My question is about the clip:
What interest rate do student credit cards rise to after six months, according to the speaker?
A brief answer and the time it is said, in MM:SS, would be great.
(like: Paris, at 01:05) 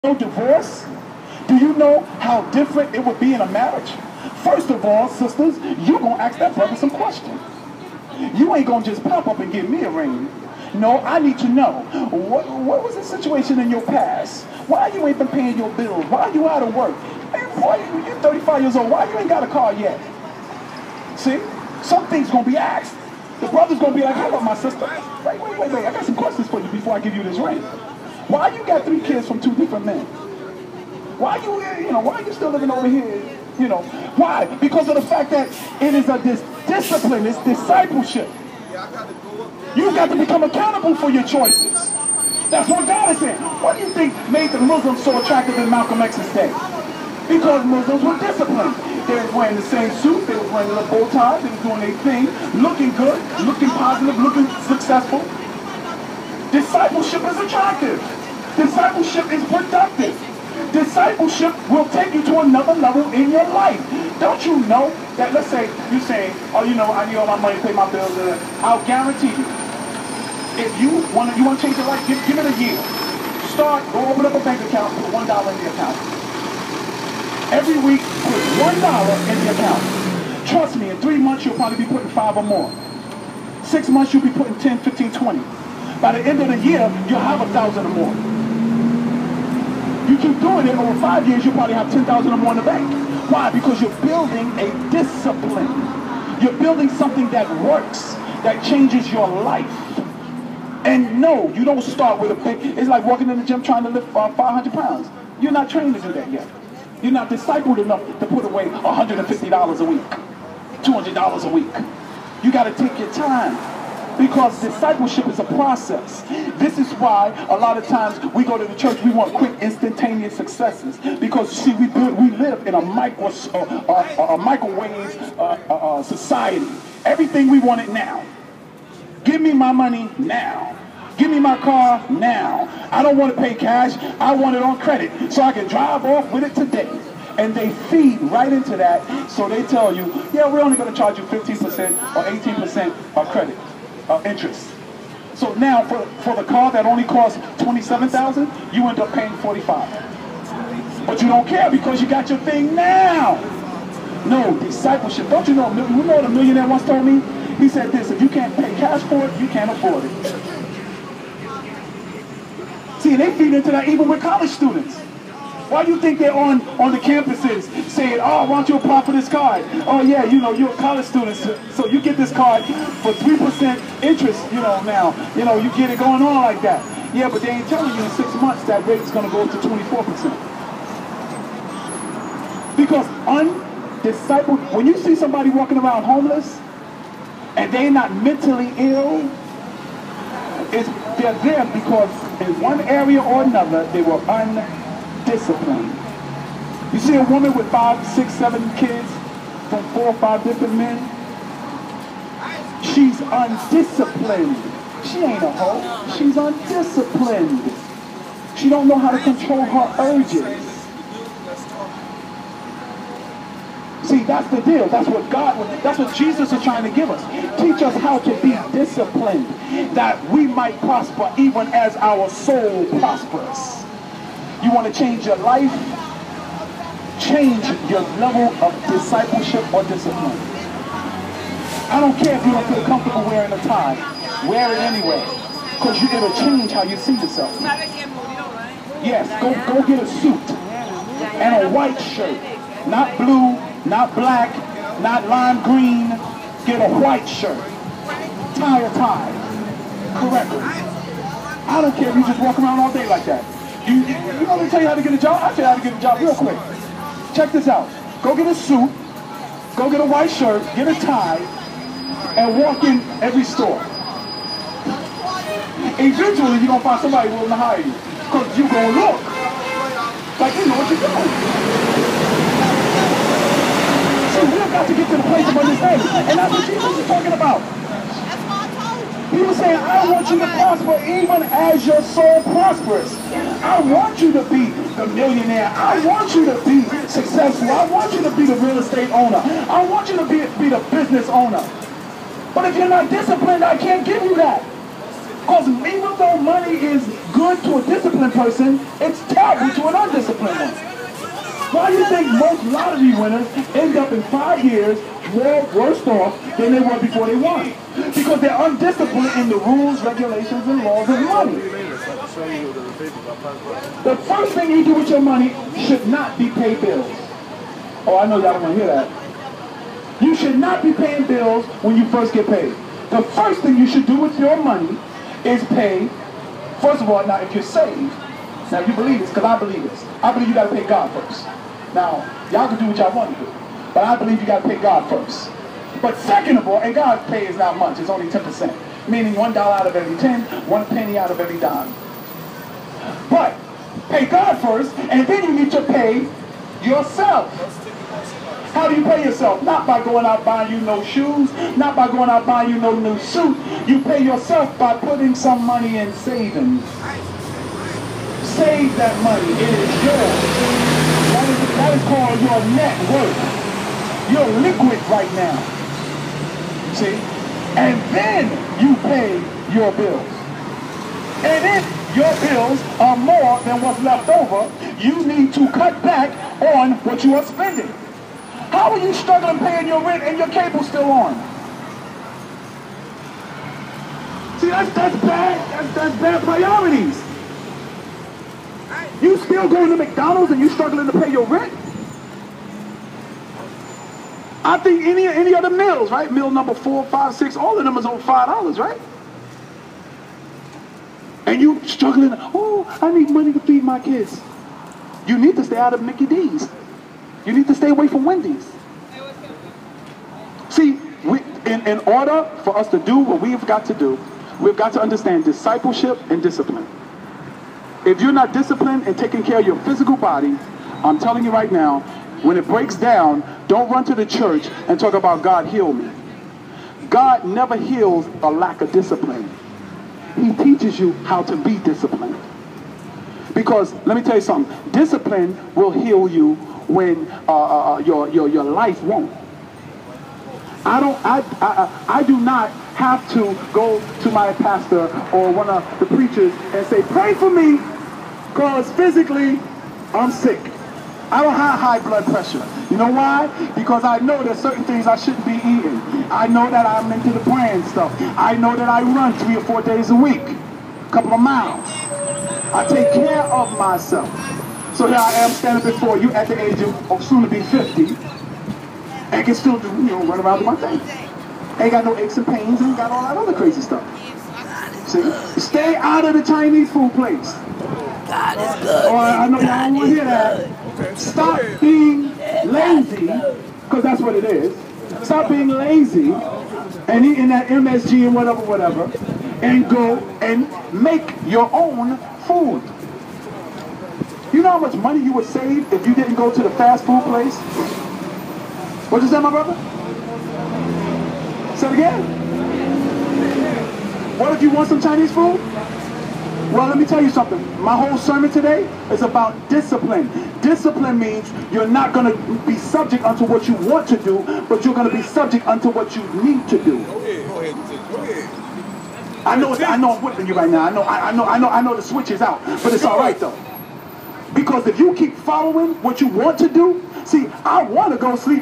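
24%, at 02:59.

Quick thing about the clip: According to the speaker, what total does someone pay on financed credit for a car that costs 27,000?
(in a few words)
45,000.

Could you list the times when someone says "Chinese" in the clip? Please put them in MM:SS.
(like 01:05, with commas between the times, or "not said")
07:56, 08:25.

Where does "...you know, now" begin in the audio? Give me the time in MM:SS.
02:54.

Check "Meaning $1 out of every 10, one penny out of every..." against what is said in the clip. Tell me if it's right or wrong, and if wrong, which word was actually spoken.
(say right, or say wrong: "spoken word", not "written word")
right.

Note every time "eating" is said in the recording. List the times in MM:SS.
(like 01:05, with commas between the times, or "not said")
07:35, 08:07.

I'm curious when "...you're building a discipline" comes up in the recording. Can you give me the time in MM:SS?
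01:33.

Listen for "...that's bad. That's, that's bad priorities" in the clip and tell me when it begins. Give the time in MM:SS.
06:24.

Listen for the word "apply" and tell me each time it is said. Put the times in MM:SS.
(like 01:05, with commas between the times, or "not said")
02:48.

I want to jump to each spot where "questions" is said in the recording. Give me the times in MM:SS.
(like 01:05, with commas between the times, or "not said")
00:06, 00:26.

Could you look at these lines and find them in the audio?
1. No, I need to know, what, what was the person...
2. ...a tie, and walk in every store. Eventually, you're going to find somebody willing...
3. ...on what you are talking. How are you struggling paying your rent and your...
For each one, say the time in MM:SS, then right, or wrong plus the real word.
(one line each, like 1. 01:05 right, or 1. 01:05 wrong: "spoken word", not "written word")
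1. 00:10 wrong: "situation", not "person"
2. 04:20 right
3. 06:16 wrong: "spending", not "talking".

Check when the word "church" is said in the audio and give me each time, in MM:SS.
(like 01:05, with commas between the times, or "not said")
01:58, 07:04.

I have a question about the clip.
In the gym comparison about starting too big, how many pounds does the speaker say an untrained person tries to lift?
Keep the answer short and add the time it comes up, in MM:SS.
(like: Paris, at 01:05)
500, at 01:44.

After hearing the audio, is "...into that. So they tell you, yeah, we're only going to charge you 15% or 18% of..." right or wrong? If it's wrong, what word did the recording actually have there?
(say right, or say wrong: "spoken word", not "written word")
right.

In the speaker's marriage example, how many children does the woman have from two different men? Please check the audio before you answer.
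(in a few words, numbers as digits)
3.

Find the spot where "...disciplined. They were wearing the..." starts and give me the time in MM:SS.
00:48.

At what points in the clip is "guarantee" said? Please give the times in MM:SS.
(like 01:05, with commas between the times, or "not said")
01:08.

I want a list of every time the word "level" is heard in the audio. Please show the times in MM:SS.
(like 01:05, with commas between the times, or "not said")
01:02, 03:48.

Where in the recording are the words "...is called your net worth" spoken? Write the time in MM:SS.
06:01.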